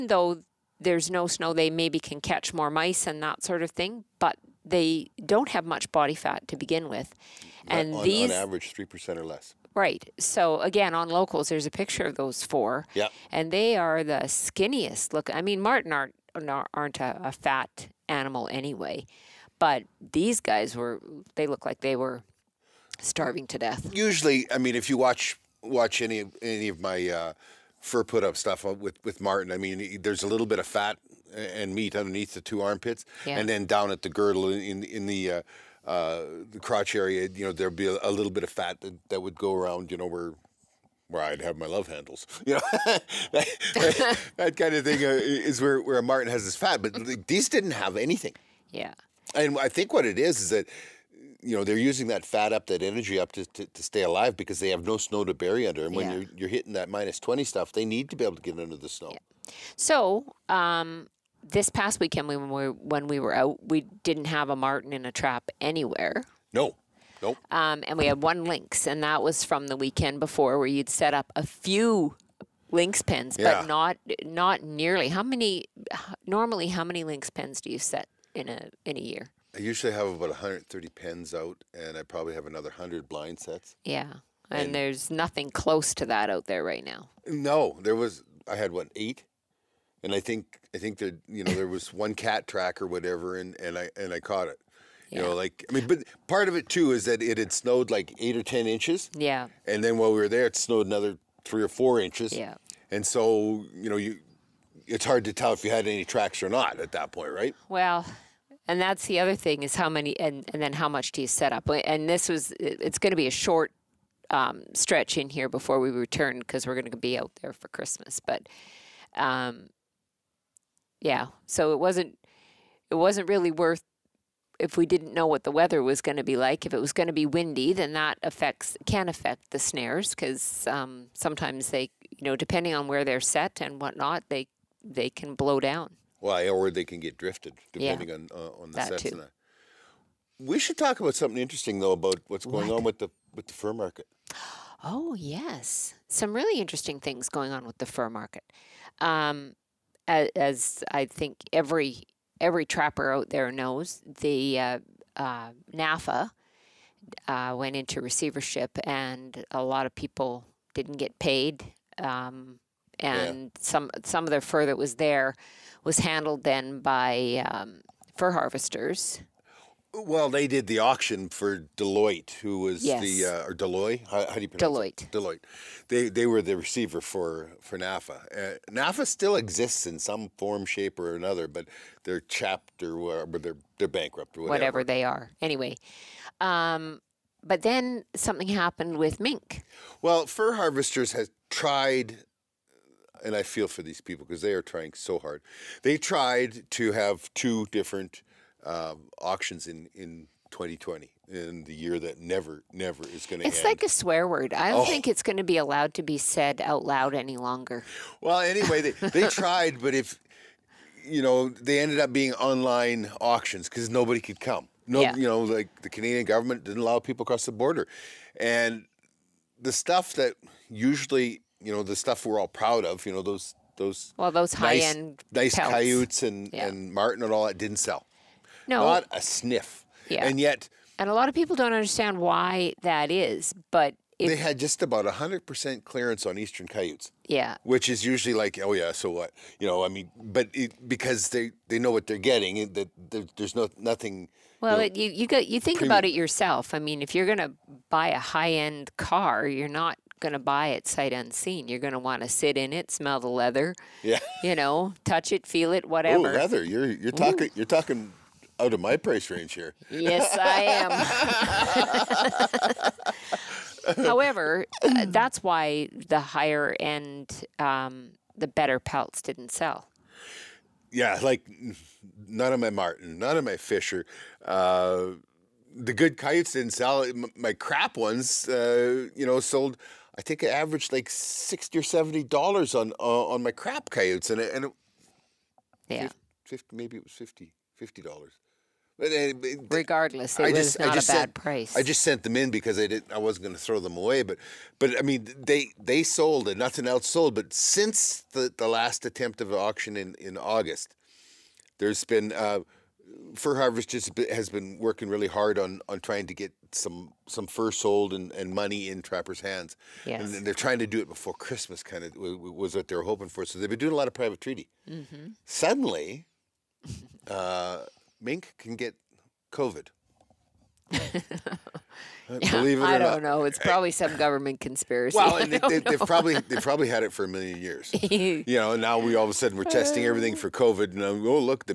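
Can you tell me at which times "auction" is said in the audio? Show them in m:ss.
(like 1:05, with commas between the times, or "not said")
2:50, 3:19, 3:33, 4:59.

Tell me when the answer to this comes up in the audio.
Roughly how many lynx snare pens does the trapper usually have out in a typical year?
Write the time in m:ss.
1:20.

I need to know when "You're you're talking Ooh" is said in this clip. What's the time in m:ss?
4:16.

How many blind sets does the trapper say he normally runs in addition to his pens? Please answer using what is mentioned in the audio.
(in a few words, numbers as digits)
100.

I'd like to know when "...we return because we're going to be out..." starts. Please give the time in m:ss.
1:55.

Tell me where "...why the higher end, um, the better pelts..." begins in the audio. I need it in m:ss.
4:25.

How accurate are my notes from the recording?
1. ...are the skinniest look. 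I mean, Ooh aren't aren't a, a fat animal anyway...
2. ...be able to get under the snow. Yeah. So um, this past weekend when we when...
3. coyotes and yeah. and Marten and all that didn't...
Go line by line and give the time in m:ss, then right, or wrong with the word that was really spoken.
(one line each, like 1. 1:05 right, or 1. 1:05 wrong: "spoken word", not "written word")
1. 0:13 wrong: "Marten", not "Ooh"
2. 0:58 right
3. 3:45 right.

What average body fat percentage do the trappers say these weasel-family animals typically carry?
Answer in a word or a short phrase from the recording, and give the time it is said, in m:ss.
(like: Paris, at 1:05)
3%, at 0:08.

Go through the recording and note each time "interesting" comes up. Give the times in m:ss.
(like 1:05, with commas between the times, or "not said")
2:21, 2:26.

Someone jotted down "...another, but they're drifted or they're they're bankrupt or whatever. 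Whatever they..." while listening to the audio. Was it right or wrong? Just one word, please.
wrong.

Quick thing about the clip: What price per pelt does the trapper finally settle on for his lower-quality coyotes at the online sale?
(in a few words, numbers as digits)
$50.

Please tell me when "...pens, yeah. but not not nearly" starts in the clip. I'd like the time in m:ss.
1:13.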